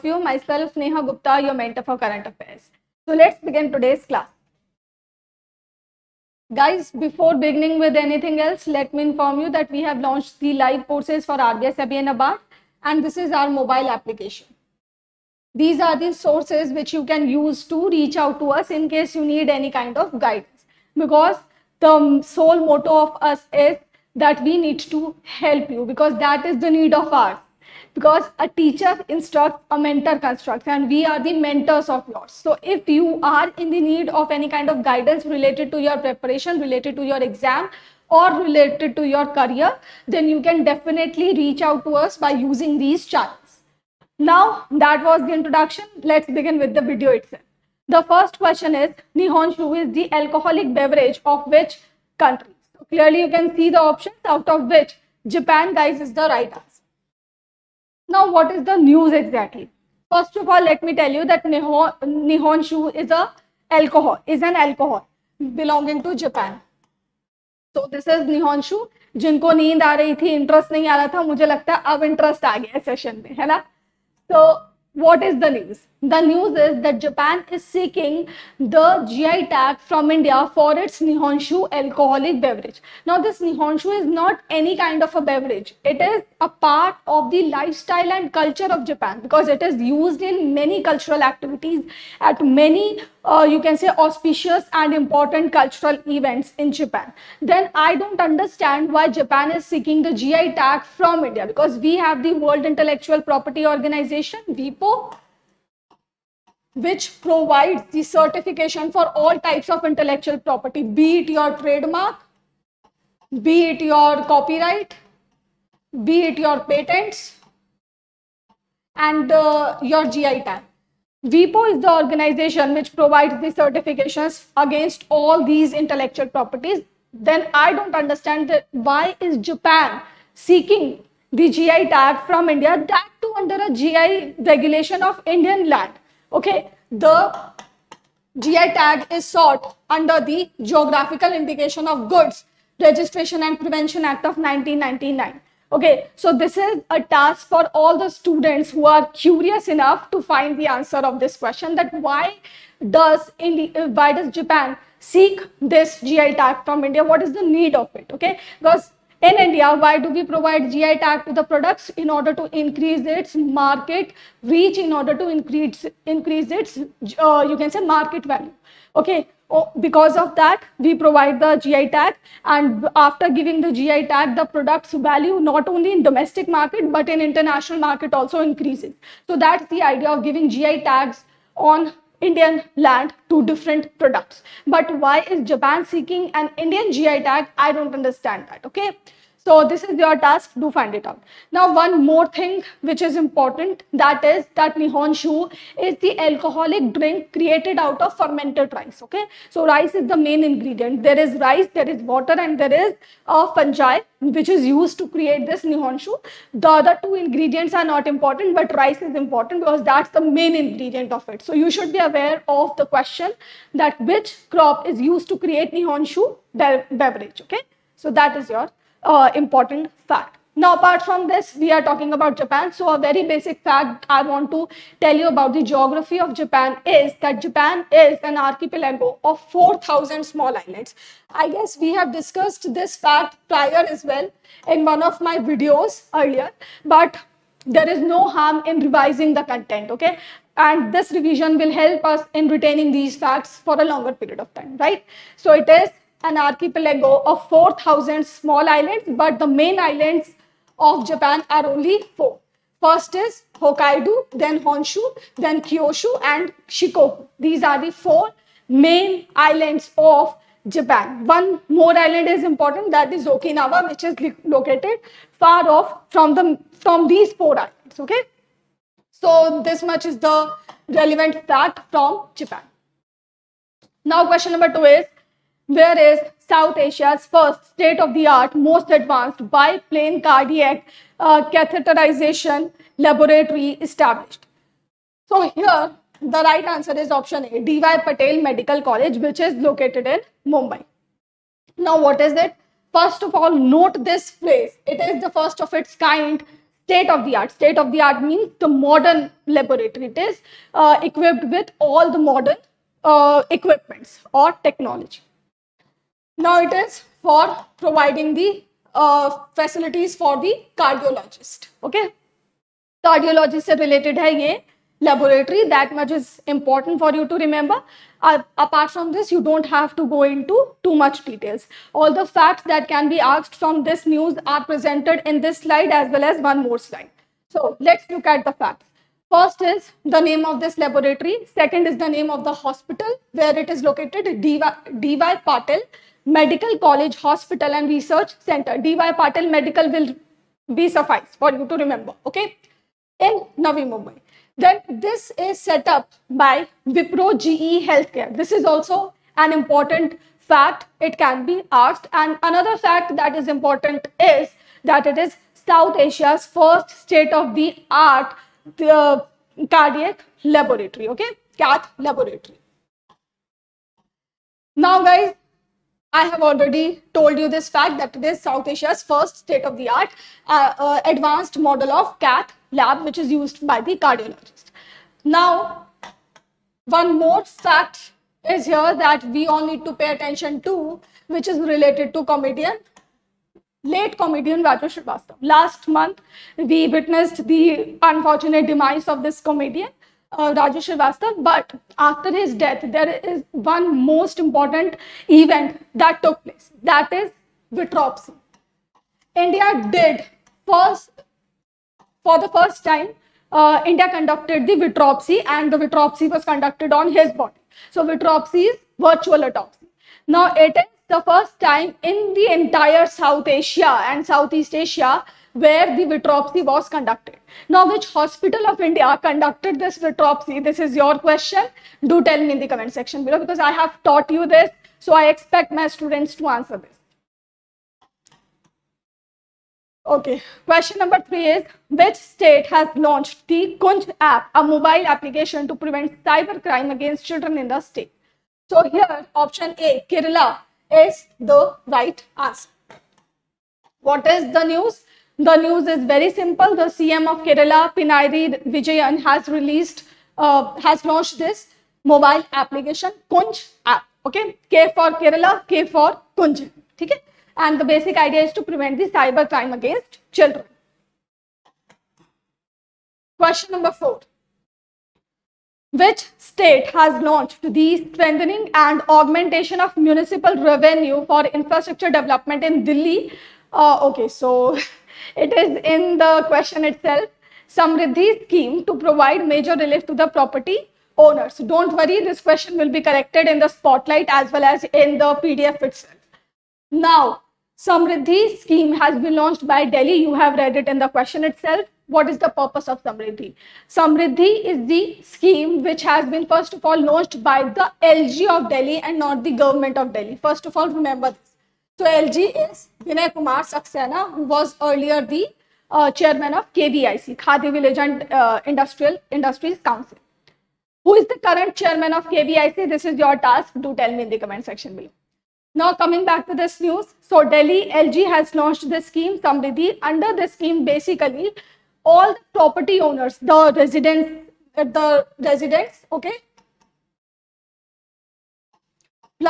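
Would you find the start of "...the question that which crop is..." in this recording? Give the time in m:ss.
3:32.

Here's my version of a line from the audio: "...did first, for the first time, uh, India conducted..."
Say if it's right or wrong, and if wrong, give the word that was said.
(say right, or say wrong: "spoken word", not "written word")
right.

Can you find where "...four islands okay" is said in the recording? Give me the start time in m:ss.
4:27.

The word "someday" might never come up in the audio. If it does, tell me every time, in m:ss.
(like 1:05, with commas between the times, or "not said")
not said.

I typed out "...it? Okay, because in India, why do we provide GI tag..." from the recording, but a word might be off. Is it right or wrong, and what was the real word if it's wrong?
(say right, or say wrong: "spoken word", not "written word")
right.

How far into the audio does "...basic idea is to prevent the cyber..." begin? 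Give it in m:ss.
7:37.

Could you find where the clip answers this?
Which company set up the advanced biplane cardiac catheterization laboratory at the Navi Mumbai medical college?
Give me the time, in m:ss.
5:46.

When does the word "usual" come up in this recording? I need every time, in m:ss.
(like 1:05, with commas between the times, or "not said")
not said.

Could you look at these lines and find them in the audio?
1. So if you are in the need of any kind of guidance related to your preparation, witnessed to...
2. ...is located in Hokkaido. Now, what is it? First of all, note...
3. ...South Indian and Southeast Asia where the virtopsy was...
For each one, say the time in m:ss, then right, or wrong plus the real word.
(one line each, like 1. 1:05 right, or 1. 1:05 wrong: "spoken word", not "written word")
1. 0:32 wrong: "related", not "witnessed"
2. 4:49 wrong: "Mumbai", not "Hokkaido"
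3. 6:53 wrong: "Asia", not "Indian".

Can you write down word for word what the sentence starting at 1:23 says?
Now this Nihonshu is not any kind of a beverage.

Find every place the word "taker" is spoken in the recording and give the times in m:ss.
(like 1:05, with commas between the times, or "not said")
not said.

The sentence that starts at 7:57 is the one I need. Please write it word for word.
Samriddhi scheme to provide major relief to the property owners.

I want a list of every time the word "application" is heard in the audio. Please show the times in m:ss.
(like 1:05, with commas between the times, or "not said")
0:13, 7:15, 7:32.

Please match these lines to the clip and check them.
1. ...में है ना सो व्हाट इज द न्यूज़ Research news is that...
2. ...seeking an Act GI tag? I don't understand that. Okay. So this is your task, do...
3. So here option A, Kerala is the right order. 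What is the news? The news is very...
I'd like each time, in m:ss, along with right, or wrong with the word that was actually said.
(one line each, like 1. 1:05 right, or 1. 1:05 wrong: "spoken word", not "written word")
1. 1:13 wrong: "The", not "Research"
2. 3:05 wrong: "Indian", not "Act"
3. 7:18 wrong: "answer", not "order".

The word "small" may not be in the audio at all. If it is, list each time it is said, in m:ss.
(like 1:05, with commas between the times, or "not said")
3:50, 4:08.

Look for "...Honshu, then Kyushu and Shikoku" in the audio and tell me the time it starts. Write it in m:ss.
4:14.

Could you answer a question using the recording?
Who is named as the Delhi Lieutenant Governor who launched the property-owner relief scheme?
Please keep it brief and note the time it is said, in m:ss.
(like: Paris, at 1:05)
Vinay Kumar Saxena, at 8:23.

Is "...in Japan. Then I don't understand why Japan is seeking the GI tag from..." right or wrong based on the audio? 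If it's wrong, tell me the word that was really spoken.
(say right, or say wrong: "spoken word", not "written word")
right.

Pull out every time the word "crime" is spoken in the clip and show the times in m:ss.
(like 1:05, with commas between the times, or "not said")
7:16, 7:39.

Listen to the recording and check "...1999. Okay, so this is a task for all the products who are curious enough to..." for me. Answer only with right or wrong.
wrong.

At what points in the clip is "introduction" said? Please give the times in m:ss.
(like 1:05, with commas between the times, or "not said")
0:45.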